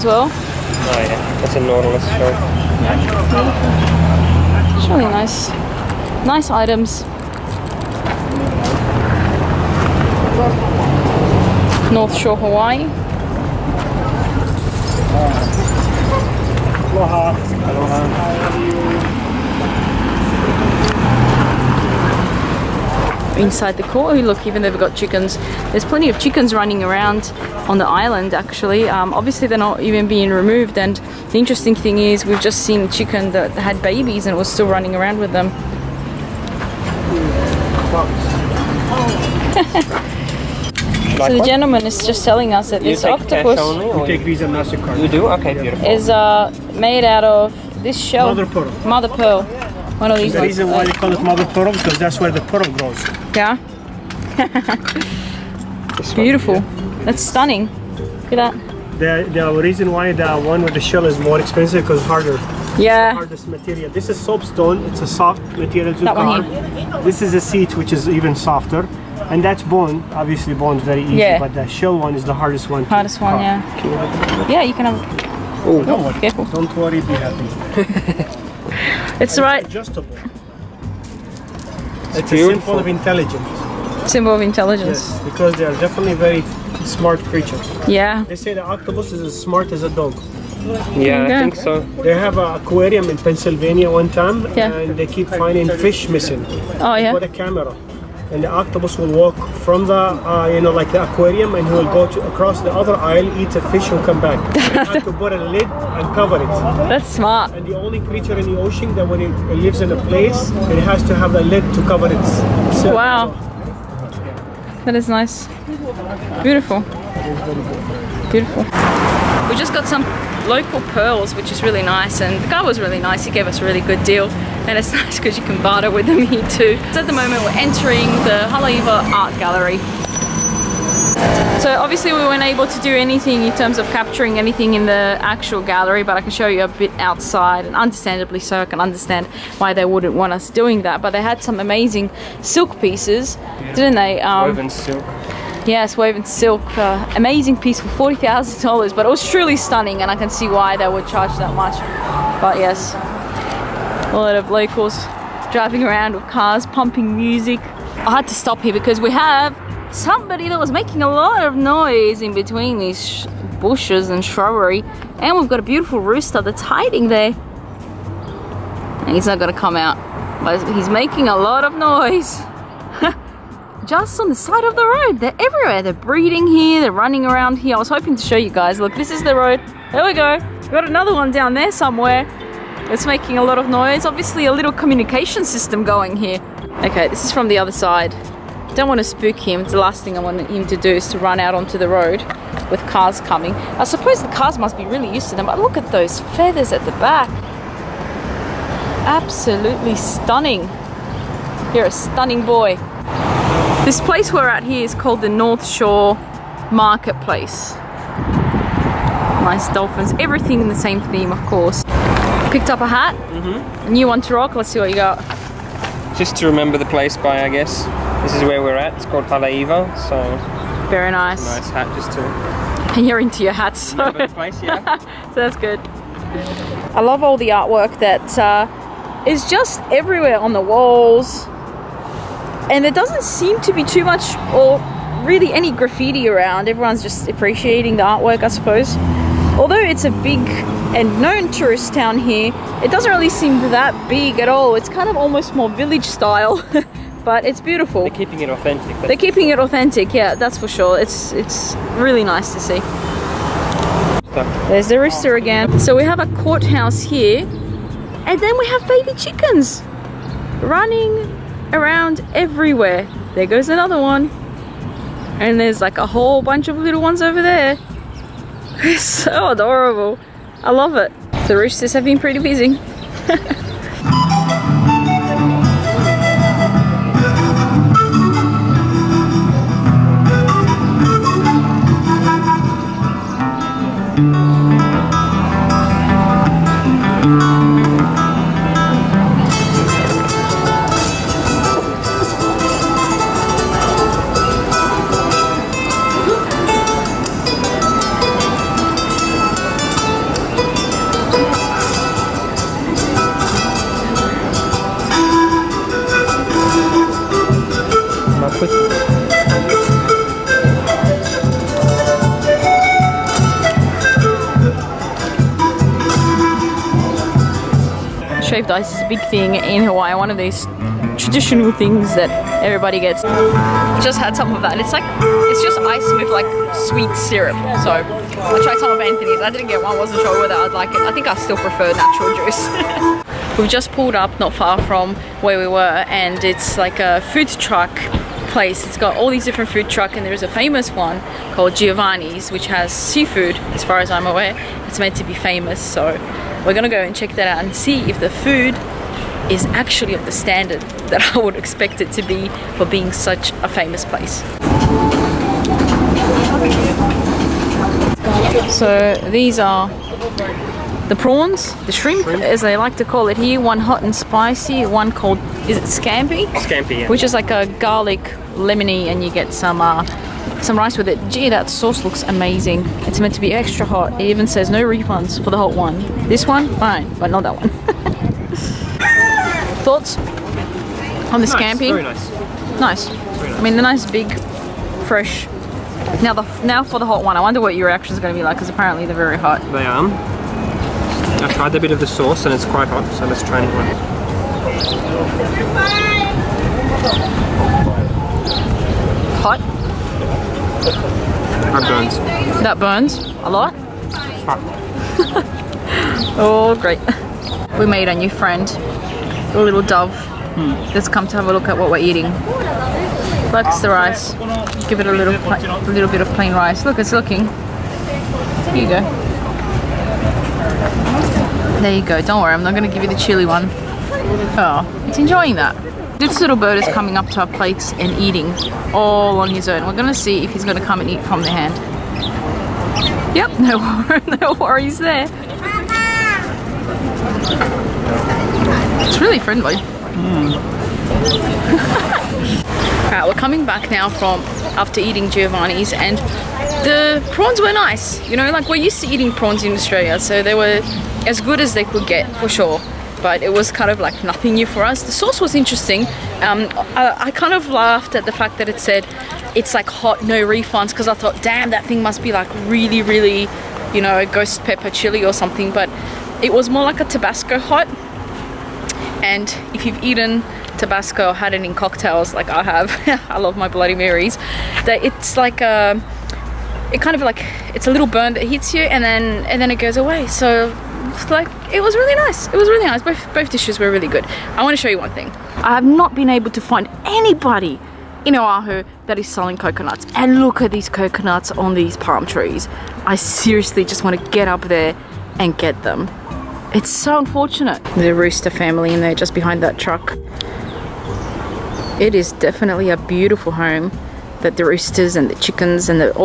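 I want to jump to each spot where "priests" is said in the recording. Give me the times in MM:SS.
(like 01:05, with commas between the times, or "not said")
not said.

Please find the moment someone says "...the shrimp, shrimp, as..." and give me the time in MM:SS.
06:01.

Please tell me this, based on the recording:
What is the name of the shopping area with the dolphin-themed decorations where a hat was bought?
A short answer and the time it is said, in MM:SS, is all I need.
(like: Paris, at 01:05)
North Shore Marketplace, at 03:25.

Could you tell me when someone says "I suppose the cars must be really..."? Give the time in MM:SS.
03:13.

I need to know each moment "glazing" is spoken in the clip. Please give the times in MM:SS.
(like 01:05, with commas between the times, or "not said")
not said.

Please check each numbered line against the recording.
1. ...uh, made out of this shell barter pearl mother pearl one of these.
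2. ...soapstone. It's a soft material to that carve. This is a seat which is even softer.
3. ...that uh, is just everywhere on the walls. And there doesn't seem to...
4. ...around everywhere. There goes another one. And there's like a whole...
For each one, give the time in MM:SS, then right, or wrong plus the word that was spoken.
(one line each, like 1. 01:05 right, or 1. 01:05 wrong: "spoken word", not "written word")
1. 00:46 wrong: "mother", not "barter"
2. 01:04 right
3. 03:47 right
4. 04:21 right.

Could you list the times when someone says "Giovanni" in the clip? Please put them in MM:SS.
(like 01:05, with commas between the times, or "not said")
05:41, 07:25.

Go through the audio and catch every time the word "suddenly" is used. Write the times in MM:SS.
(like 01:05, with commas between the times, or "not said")
not said.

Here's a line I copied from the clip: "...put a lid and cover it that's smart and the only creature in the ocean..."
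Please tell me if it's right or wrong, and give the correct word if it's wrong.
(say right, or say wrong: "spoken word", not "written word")
right.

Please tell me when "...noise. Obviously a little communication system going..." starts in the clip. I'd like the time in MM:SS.
03:03.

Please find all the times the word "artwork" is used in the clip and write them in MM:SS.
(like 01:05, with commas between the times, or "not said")
03:47, 03:58.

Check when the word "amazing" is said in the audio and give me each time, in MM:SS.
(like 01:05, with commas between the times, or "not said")
02:21, 02:27, 06:12.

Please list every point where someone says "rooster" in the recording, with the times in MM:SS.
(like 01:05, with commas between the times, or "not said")
02:45, 04:14, 04:31, 08:18, 08:24.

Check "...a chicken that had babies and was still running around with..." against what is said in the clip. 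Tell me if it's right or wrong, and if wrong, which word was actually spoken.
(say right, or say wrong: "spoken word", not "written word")
right.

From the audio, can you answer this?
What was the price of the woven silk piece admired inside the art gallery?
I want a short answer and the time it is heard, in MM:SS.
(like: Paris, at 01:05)
$40,000, at 02:28.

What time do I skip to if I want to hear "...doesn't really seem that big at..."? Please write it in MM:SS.
04:02.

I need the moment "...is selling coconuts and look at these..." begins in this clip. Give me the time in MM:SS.
08:09.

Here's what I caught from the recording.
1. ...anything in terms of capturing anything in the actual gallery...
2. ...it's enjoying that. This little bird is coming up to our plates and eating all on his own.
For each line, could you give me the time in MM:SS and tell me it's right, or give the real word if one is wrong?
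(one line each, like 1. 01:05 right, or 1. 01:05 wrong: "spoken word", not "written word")
1. 02:12 right
2. 07:05 right.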